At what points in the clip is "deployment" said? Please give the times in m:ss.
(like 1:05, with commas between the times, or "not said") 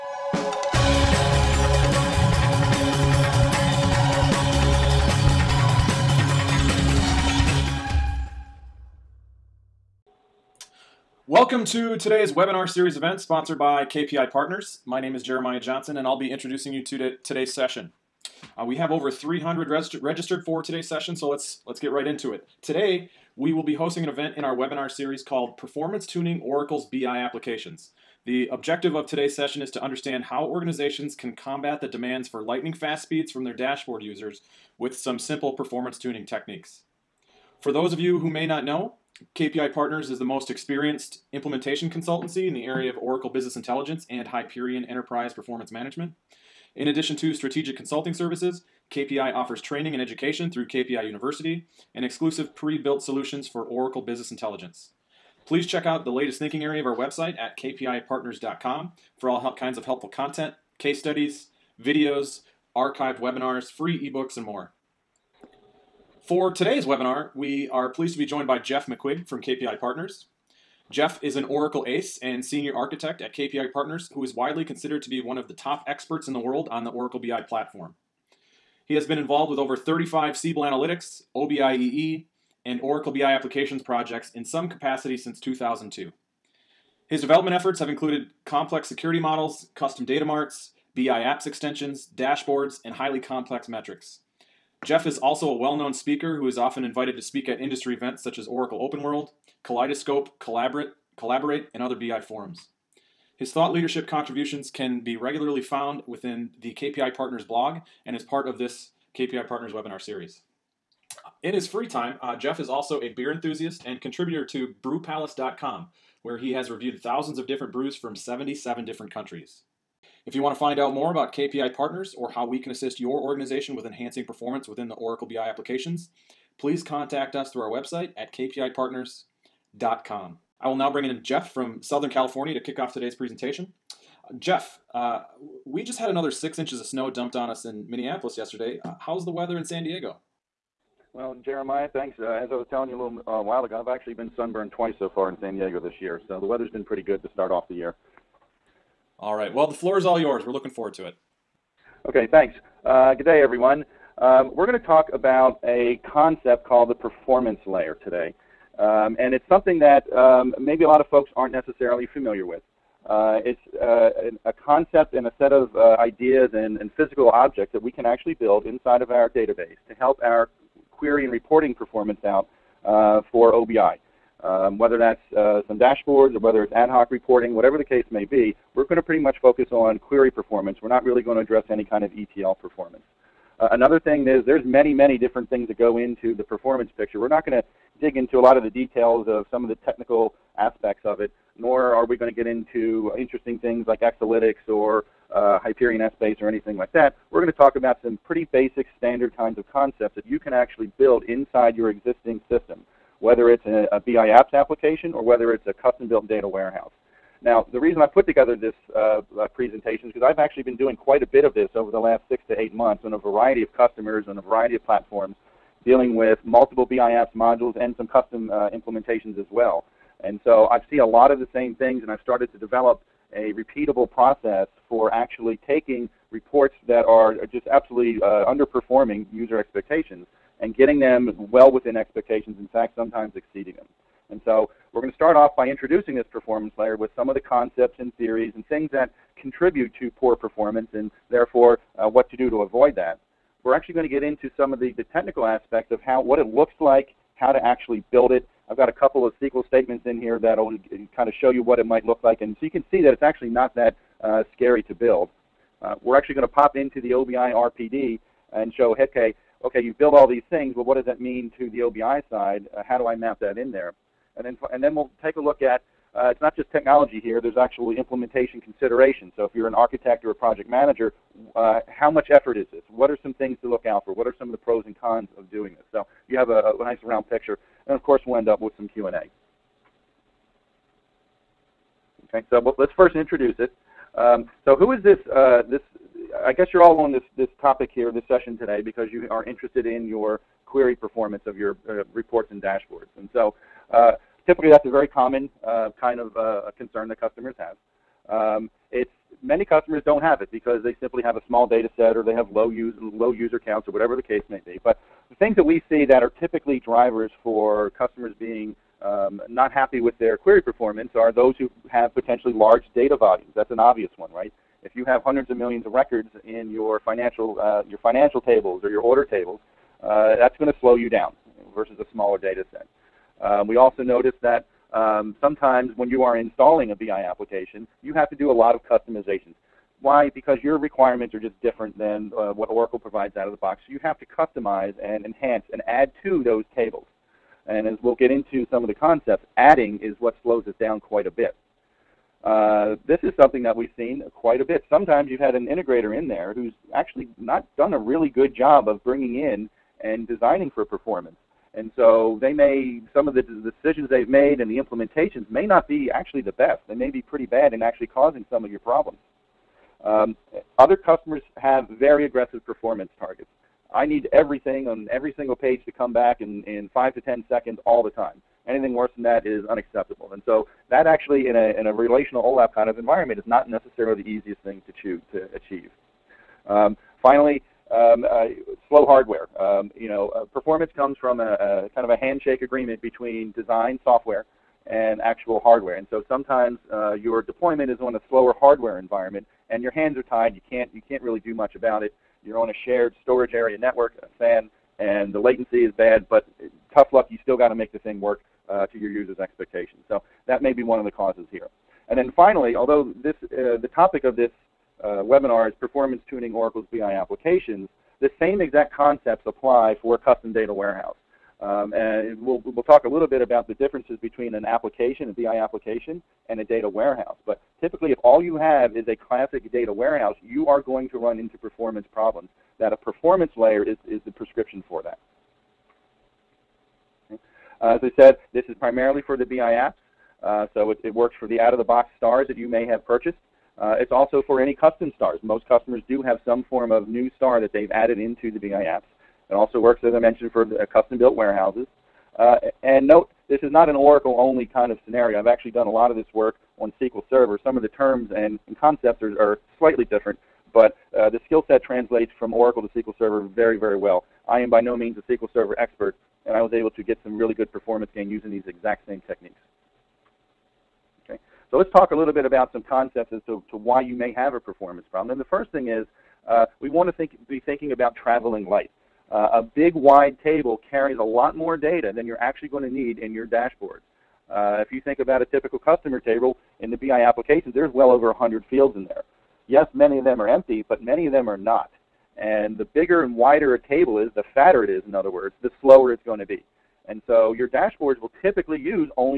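6:27.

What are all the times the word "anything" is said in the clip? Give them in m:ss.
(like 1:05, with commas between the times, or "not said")
3:16, 6:08.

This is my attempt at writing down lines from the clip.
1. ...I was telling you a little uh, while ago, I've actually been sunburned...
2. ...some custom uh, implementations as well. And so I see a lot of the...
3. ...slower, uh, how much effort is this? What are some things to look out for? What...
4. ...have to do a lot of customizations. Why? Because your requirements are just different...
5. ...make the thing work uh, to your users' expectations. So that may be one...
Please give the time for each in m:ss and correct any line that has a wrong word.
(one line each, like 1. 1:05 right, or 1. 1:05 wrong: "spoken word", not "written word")
1. 2:22 right
2. 3:37 right
3. 4:30 wrong: "manager", not "slower"
4. 5:28 right
5. 6:37 right.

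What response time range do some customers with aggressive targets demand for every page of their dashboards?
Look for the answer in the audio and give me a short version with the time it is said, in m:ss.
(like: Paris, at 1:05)
5 to 10 seconds, at 6:06.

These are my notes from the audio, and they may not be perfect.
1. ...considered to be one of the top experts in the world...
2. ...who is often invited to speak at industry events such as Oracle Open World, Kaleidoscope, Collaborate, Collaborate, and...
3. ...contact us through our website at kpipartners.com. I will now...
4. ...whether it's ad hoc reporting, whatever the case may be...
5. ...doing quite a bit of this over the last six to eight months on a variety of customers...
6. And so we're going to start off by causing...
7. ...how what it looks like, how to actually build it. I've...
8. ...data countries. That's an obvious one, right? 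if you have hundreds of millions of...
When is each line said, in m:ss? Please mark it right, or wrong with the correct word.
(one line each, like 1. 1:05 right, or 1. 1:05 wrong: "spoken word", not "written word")
1. 1:14 right
2. 1:36 right
3. 2:06 right
4. 2:56 right
5. 3:30 right
6. 3:54 wrong: "introducing", not "causing"
7. 4:06 right
8. 5:12 wrong: "volumes", not "countries".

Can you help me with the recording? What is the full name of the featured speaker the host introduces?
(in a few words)
Jeff McQuigg.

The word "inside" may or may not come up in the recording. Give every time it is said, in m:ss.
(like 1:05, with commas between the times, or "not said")
2:48, 3:21.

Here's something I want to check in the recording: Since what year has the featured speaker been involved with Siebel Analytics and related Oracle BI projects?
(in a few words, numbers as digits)
2002.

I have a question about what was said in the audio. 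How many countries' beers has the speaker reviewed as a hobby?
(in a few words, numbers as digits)
77.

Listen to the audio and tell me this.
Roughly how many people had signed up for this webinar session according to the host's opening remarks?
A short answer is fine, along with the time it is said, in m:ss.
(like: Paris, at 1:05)
over 300, at 0:18.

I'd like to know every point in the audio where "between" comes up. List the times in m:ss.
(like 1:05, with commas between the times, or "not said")
6:23, 6:54.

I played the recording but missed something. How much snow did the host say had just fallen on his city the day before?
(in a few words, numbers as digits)
six inches.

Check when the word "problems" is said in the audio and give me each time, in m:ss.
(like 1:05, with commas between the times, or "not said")
5:58, 7:02, 7:45.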